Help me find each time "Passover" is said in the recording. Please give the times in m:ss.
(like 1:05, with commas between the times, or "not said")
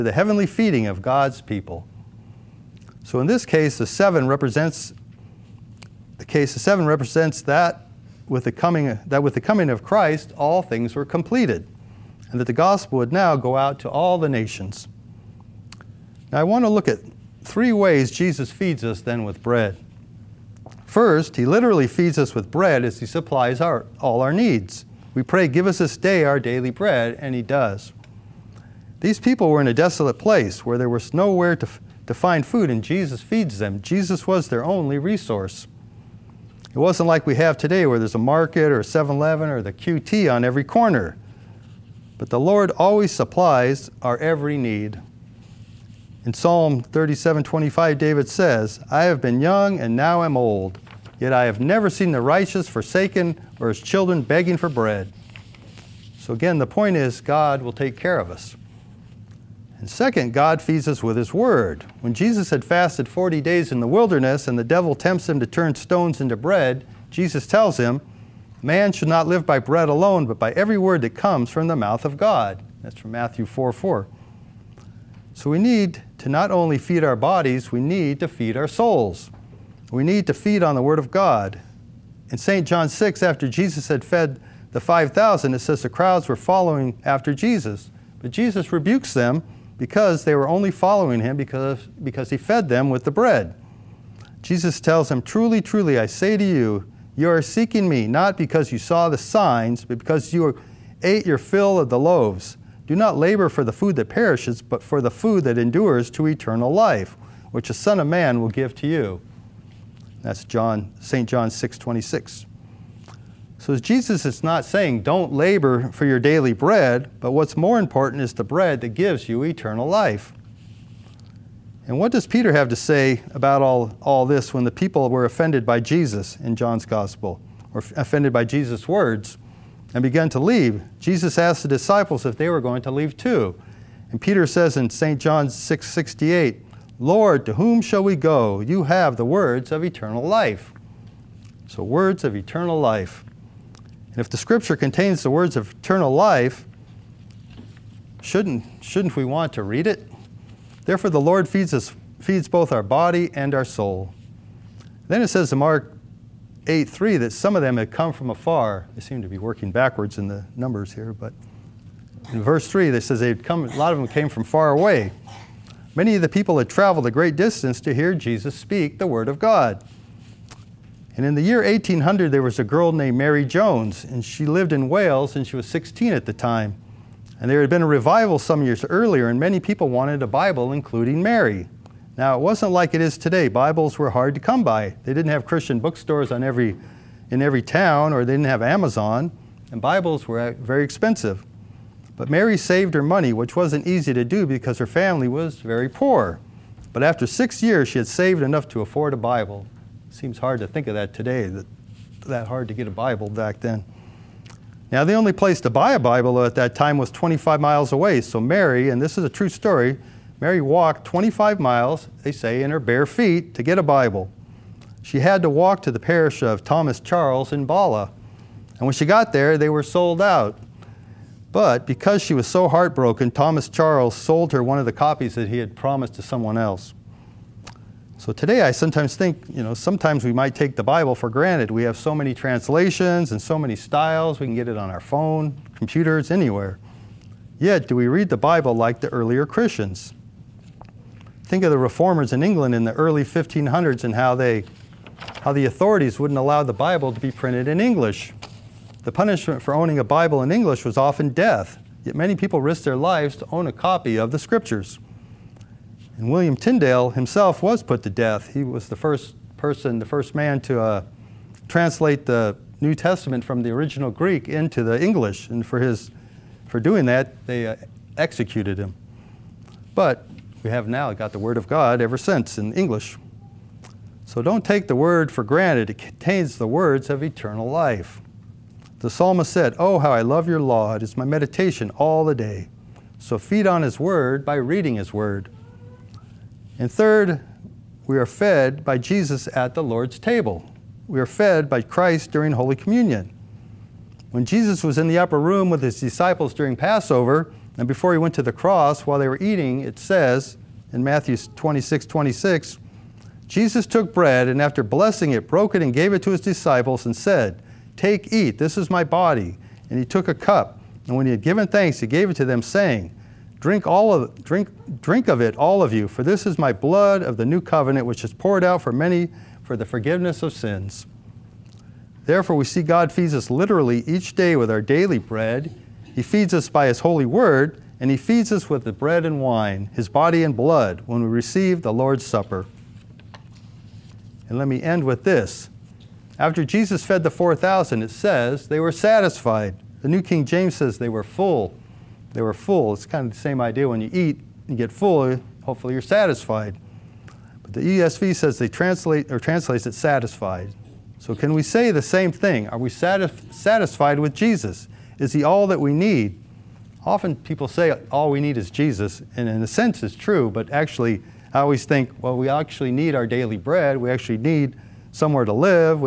4:56.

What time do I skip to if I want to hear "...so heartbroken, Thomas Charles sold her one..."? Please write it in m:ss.
3:42.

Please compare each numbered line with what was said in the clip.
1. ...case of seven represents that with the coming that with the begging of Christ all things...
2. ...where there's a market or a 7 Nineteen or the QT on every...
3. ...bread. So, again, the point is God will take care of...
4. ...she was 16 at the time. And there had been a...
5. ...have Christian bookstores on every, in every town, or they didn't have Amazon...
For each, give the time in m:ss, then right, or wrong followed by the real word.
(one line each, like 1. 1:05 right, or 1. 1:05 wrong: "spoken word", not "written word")
1. 0:06 wrong: "coming", not "begging"
2. 0:37 wrong: "Eleven", not "Nineteen"
3. 0:54 right
4. 2:55 right
5. 3:05 right.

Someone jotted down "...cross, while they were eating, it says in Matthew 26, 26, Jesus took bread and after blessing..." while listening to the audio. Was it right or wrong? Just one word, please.
right.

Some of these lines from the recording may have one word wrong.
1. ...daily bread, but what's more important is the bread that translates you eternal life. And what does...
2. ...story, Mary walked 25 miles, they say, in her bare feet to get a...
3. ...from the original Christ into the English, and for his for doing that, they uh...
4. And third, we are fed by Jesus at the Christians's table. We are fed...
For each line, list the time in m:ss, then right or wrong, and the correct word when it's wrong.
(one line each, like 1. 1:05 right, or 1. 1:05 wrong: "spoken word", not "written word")
1. 1:56 wrong: "gives", not "translates"
2. 3:29 right
3. 4:23 wrong: "Greek", not "Christ"
4. 4:46 wrong: "Lord", not "Christians".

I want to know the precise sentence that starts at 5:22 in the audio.
Therefore, we see God feeds us literally each day with our daily bread.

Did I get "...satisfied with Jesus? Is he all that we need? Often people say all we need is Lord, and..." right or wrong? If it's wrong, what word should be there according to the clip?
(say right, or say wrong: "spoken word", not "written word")
wrong: "Jesus", not "Lord".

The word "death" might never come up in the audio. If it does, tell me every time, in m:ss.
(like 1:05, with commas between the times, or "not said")
4:11, 4:18.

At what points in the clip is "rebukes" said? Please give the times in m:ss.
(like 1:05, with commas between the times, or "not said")
1:28.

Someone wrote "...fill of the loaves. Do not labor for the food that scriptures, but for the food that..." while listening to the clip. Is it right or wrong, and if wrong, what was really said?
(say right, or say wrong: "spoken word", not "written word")
wrong: "perishes", not "scriptures".